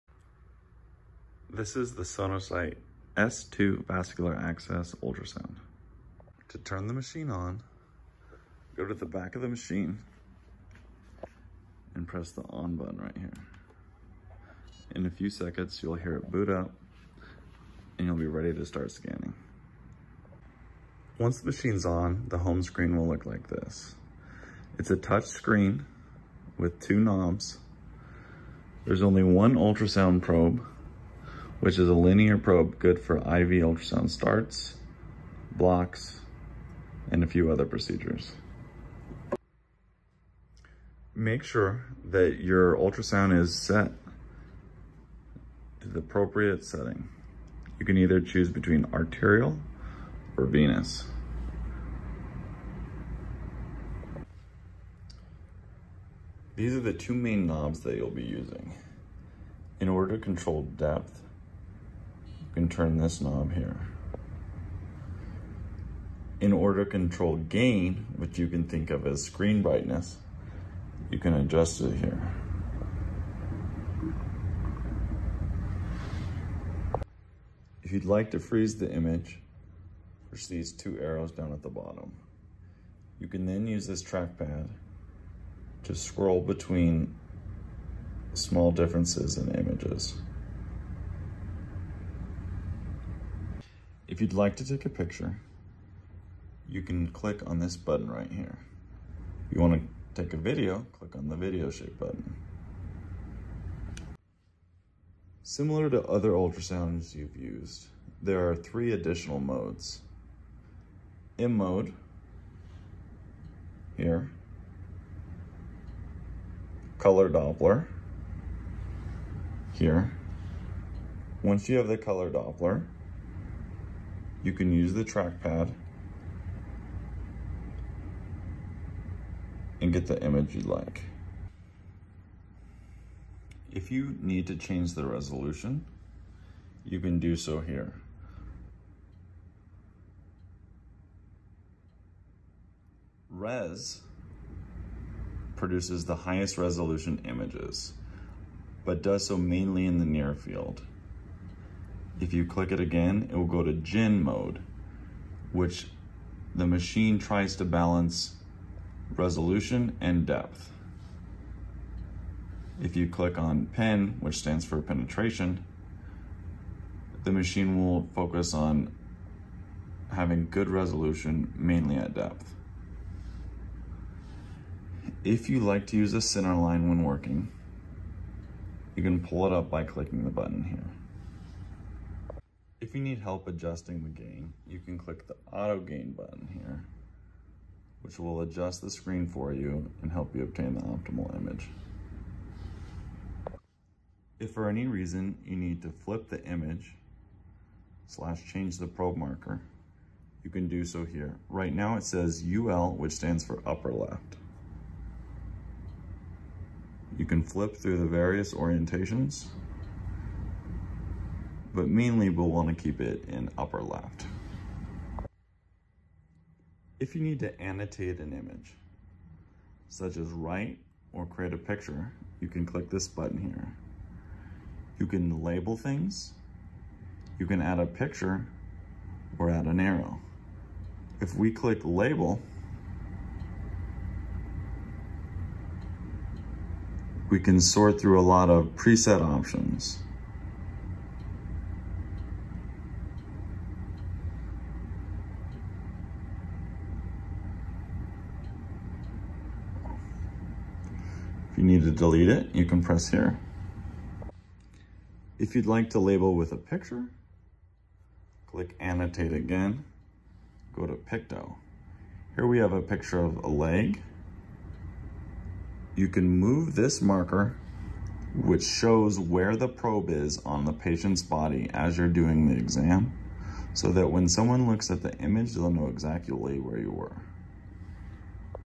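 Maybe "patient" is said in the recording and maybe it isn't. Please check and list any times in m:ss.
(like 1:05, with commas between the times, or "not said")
4:30.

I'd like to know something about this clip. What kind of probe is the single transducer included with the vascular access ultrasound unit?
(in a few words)
linear probe.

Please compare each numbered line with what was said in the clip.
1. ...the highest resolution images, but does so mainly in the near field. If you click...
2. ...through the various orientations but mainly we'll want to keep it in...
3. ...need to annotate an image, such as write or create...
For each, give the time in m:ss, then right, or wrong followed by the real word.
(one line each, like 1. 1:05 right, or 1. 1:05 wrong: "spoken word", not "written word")
1. 2:26 right
2. 3:27 right
3. 3:37 right.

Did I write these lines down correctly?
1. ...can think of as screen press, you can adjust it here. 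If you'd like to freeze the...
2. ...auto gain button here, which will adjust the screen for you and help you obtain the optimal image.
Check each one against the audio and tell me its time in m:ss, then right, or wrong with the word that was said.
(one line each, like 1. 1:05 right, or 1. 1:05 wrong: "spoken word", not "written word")
1. 1:08 wrong: "brightness", not "press"
2. 3:05 right.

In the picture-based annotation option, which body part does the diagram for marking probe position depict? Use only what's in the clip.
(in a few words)
leg.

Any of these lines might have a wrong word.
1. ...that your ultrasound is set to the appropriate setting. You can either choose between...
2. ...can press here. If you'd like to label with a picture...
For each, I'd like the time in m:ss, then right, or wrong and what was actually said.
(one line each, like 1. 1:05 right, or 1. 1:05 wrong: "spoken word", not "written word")
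1. 0:42 right
2. 4:12 right.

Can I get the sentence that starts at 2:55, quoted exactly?
If you like to use a center line when working, you can pull it up by clicking the button here.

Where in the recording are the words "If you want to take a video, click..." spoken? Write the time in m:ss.
1:39.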